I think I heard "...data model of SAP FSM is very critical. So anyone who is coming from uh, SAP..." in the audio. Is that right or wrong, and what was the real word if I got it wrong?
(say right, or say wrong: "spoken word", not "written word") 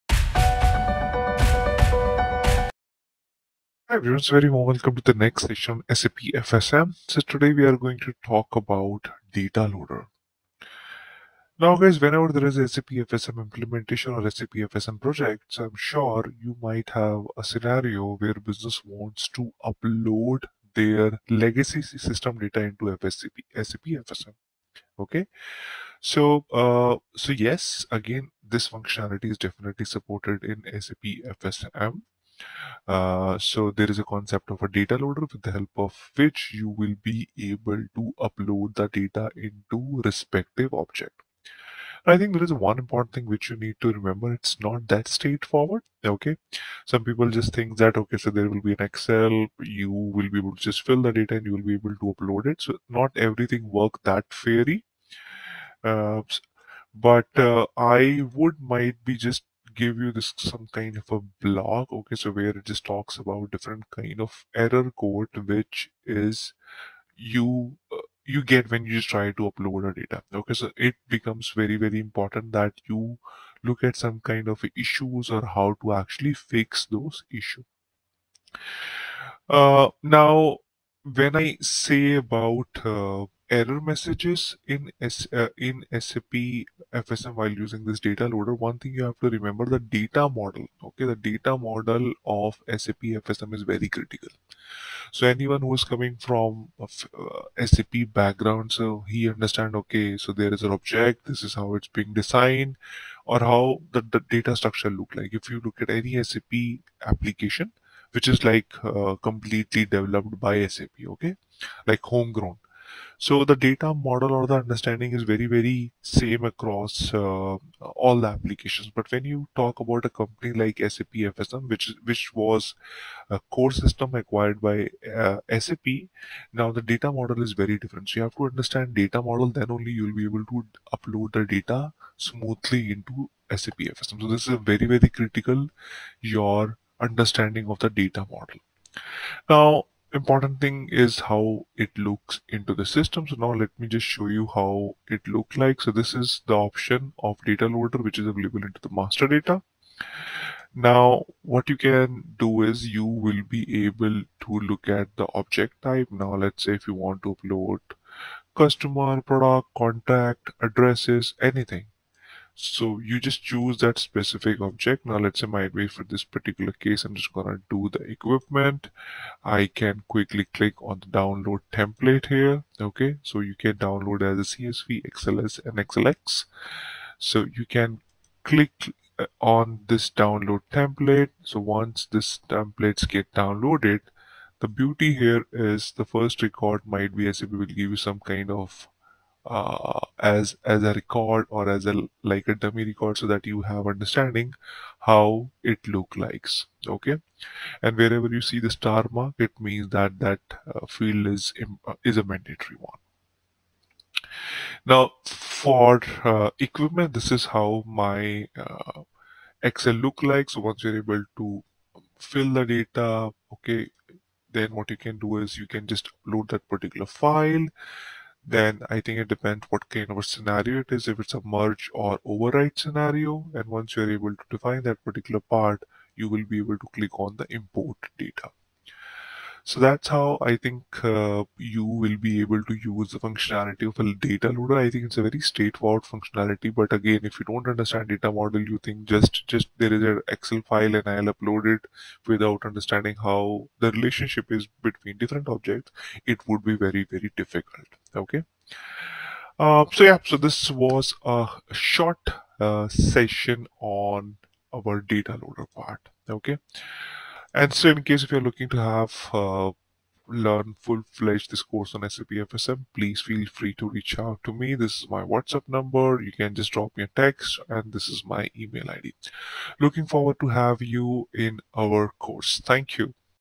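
right.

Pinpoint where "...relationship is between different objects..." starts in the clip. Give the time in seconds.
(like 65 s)
243 s.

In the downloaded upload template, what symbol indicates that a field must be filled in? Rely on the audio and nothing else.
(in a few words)
star mark.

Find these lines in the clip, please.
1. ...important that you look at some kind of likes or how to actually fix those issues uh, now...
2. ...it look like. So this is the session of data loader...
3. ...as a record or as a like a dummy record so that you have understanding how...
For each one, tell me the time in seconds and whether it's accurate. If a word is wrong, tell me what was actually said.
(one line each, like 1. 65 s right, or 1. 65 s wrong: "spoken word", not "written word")
1. 71 s wrong: "issues", not "likes"
2. 145 s wrong: "option", not "session"
3. 190 s right.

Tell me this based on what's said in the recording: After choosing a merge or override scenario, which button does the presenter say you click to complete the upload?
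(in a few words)
import data.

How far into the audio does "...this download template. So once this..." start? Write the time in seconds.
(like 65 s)
179 s.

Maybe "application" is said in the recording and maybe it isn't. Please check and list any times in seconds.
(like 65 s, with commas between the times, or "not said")
107 s, 118 s.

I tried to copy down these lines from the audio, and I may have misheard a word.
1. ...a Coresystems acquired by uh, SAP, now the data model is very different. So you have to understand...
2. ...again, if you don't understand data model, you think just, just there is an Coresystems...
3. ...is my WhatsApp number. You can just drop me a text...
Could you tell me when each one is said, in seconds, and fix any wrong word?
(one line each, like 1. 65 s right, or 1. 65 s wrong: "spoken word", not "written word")
1. 123 s right
2. 236 s wrong: "Excel", not "Coresystems"
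3. 265 s right.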